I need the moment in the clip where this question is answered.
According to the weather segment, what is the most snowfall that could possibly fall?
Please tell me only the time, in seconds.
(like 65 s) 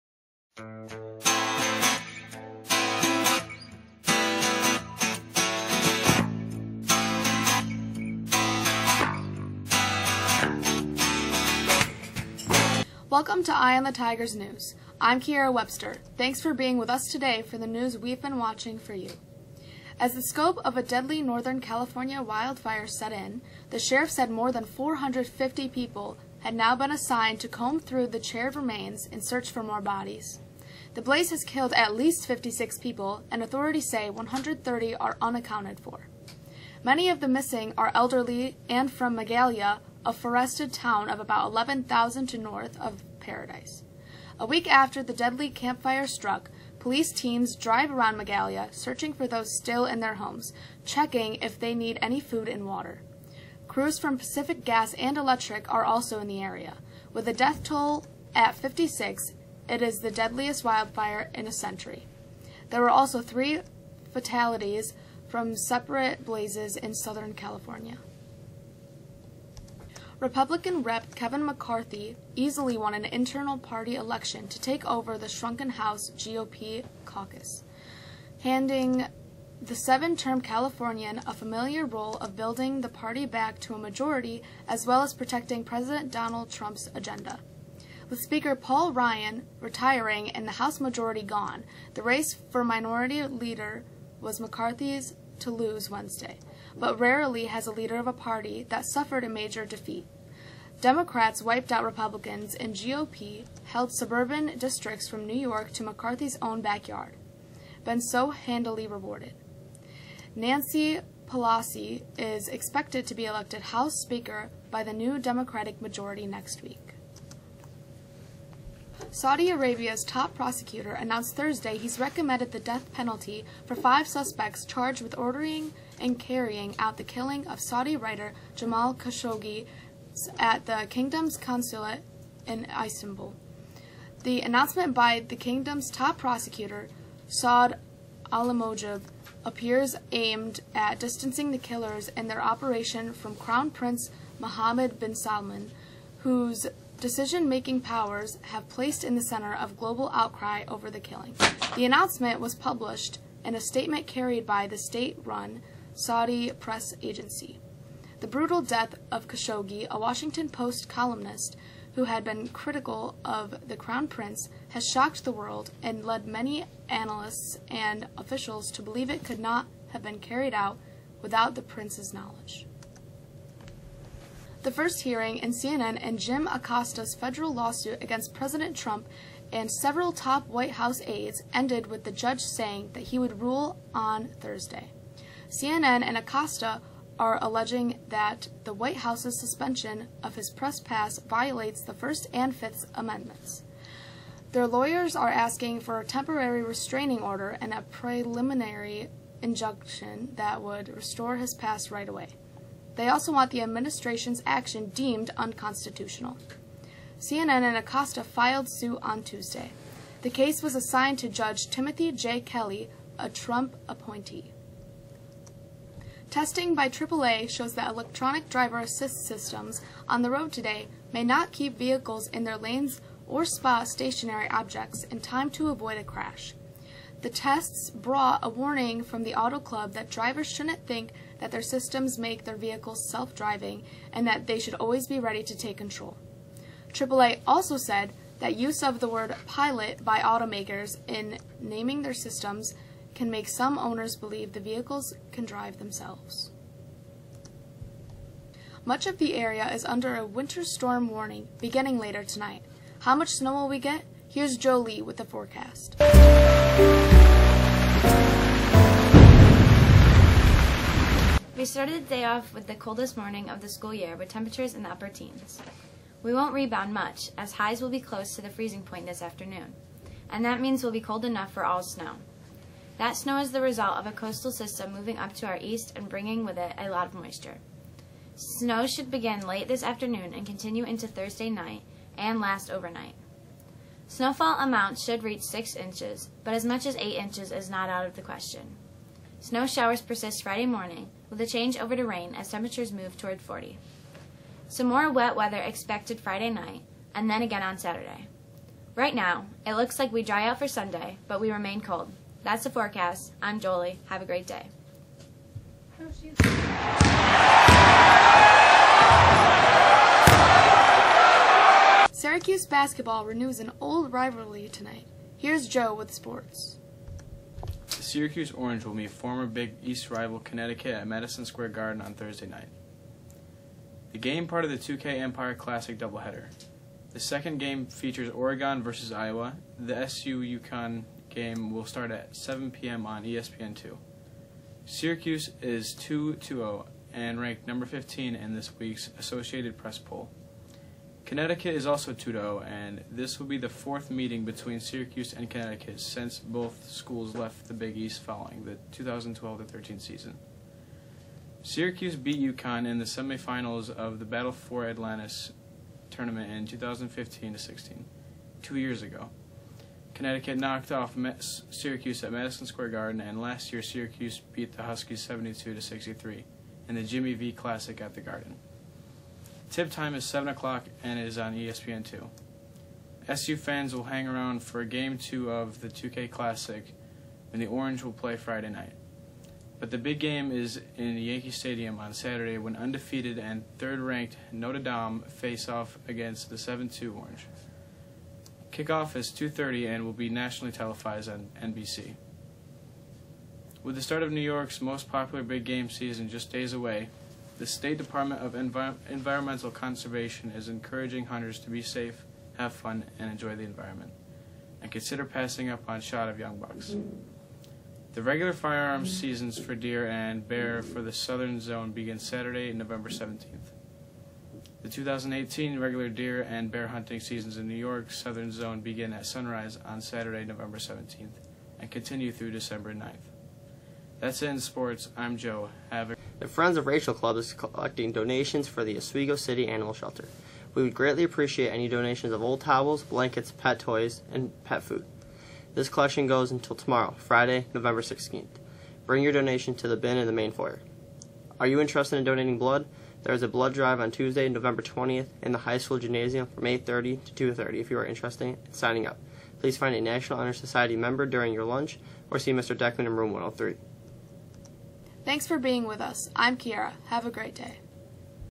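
286 s.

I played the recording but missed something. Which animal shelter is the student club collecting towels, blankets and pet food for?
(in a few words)
Oswego City Animal Shelter.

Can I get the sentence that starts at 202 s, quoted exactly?
They also want the administration's action deemed unconstitutional.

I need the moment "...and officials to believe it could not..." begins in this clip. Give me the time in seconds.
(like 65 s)
167 s.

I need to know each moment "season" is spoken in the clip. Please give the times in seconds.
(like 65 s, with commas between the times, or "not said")
350 s, 395 s, 409 s, 417 s.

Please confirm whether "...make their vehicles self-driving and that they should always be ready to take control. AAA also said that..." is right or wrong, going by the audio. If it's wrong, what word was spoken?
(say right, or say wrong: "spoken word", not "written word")
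right.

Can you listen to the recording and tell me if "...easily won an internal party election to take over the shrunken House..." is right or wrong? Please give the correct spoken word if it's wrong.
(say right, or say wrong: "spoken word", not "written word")
right.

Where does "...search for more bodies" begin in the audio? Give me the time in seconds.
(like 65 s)
29 s.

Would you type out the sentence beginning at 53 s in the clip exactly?
Crews from Pacific Gas and Electric are also in the area.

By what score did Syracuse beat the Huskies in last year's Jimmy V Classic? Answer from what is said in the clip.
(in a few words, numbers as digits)
72 to 63.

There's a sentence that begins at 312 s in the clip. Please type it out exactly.
Syracuse basketball renews an old rivalry tonight.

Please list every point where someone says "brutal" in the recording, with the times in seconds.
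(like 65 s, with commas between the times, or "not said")
158 s.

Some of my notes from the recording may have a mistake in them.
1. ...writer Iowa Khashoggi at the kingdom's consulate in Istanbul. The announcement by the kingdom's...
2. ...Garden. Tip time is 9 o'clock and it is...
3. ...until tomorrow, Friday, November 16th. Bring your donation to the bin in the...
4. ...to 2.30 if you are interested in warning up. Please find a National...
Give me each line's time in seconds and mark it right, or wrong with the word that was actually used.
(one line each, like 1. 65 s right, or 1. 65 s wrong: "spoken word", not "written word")
1. 127 s wrong: "Jamal", not "Iowa"
2. 368 s wrong: "7", not "9"
3. 436 s right
4. 447 s wrong: "signing", not "warning".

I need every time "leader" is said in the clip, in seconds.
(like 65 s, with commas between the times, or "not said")
93 s, 97 s.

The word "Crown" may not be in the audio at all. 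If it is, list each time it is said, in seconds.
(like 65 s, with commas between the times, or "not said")
143 s, 163 s.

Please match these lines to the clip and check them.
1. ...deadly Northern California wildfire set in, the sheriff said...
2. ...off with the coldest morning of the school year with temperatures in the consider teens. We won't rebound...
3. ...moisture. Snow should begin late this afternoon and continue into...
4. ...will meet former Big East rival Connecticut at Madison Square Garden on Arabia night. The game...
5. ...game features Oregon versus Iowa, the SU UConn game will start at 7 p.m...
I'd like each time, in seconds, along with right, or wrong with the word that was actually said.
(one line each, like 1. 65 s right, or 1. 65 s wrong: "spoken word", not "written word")
1. 20 s right
2. 262 s wrong: "upper", not "consider"
3. 277 s right
4. 318 s wrong: "Thursday", not "Arabia"
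5. 327 s right.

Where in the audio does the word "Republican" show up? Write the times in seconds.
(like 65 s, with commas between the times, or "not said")
70 s, 101 s.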